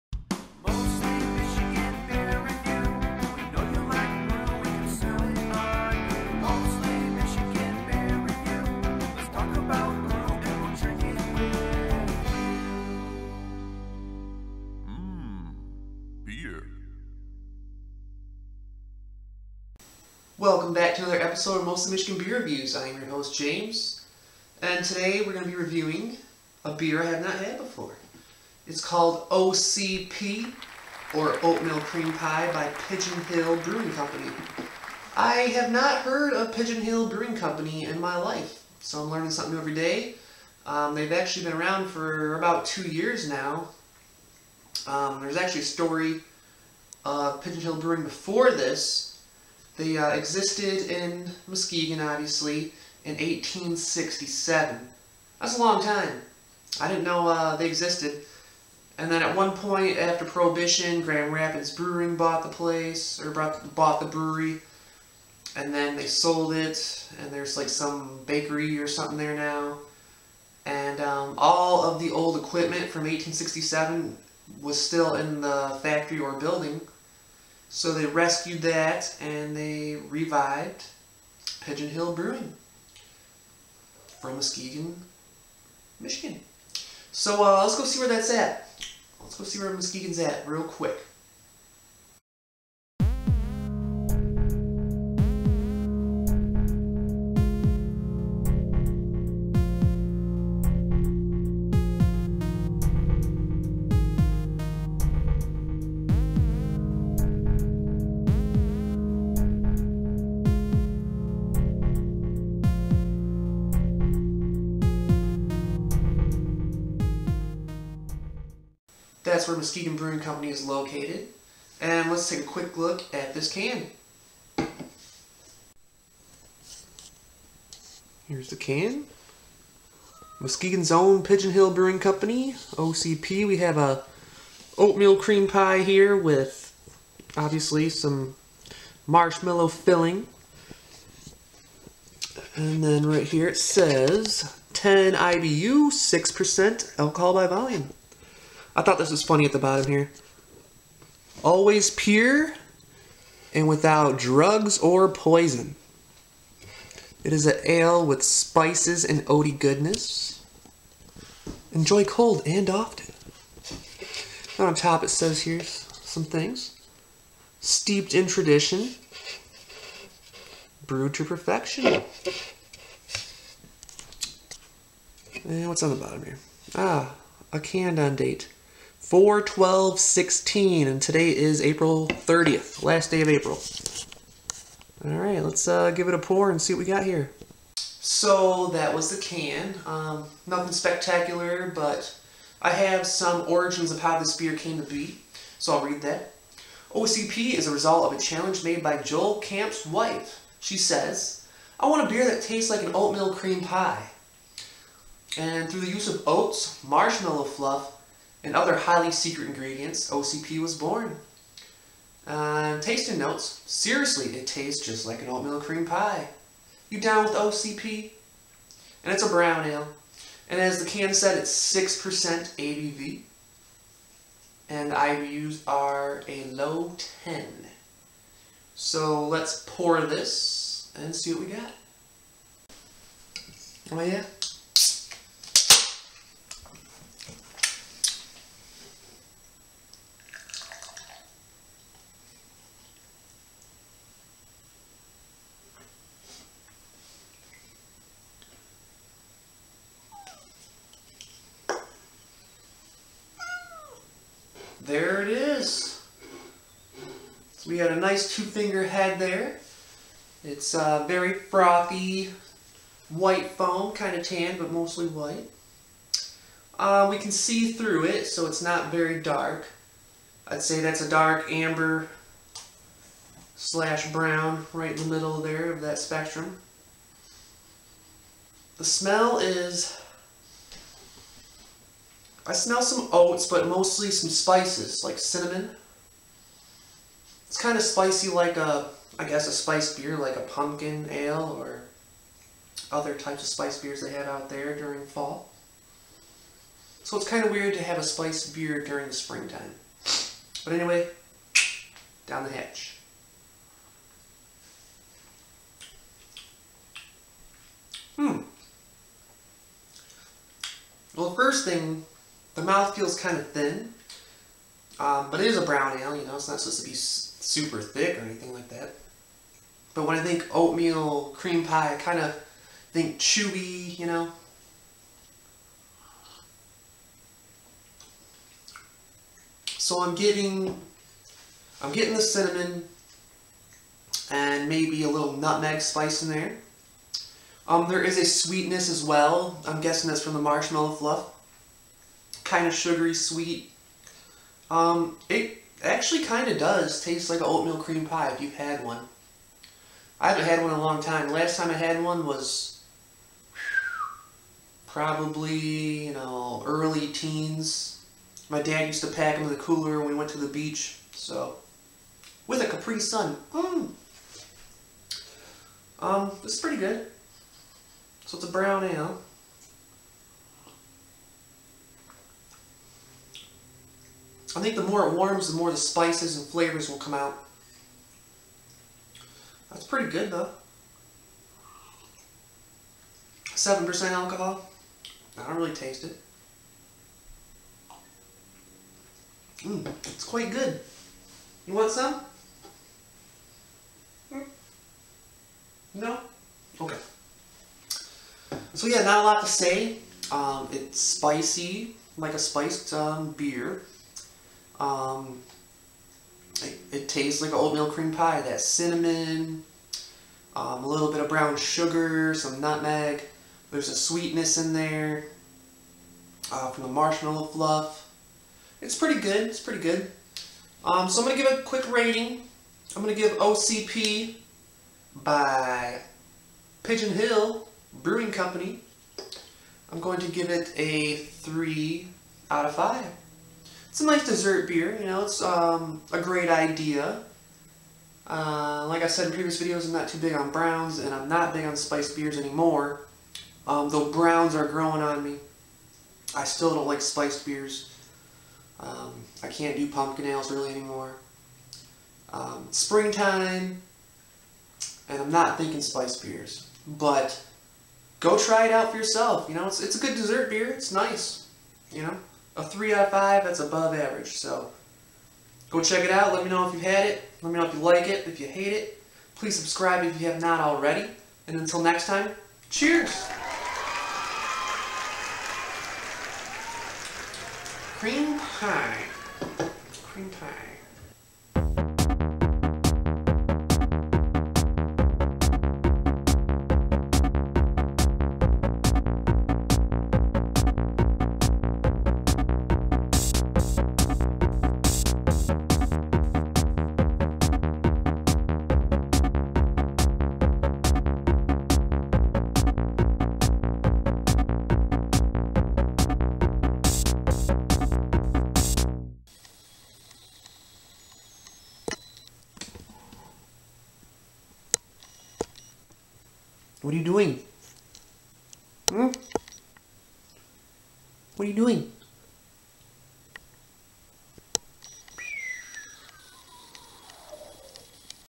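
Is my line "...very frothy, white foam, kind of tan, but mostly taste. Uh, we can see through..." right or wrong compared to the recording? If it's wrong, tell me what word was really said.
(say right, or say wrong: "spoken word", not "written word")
wrong: "white", not "taste".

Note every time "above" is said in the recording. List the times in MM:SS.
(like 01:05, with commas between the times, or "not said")
07:43.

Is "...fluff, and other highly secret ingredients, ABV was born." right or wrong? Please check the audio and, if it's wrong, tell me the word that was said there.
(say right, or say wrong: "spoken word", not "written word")
wrong: "OCP", not "ABV".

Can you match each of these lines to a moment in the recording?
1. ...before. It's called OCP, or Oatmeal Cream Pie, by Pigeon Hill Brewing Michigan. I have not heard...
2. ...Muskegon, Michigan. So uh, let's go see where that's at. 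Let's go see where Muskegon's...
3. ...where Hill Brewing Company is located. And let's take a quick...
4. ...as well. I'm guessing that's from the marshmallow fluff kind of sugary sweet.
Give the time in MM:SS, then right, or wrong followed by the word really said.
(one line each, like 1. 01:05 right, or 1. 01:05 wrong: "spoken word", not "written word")
1. 00:27 wrong: "Company", not "Michigan"
2. 01:24 right
3. 01:59 wrong: "Muskegon", not "Hill"
4. 05:38 right.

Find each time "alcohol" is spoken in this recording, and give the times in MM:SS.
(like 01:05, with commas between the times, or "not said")
02:26, 06:24.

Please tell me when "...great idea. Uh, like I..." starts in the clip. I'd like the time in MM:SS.
07:16.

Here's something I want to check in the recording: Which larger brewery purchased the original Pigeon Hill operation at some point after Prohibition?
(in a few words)
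Grand Rapids Brewing.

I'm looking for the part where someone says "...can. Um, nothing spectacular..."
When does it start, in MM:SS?
03:09.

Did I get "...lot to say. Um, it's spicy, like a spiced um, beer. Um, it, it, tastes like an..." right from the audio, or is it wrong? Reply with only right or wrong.
right.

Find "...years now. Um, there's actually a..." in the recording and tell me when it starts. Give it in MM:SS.
00:42.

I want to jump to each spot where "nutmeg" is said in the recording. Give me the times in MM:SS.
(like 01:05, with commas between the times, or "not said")
05:35, 06:52.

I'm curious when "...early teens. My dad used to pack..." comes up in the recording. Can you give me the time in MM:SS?
05:56.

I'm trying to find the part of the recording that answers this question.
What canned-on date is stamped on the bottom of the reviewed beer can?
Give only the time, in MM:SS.
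02:59.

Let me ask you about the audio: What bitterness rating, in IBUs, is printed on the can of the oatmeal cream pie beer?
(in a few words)
10.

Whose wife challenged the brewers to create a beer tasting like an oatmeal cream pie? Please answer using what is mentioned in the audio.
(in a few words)
Joel Camp.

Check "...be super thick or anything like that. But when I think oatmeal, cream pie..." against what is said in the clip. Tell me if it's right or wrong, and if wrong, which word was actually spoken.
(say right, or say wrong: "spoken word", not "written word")
right.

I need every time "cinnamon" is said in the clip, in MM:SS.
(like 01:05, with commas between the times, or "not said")
04:45, 05:32, 06:48.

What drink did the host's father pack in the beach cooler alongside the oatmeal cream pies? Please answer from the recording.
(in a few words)
Capri Sun.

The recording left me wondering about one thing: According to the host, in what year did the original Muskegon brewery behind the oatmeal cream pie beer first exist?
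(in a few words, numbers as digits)
1867.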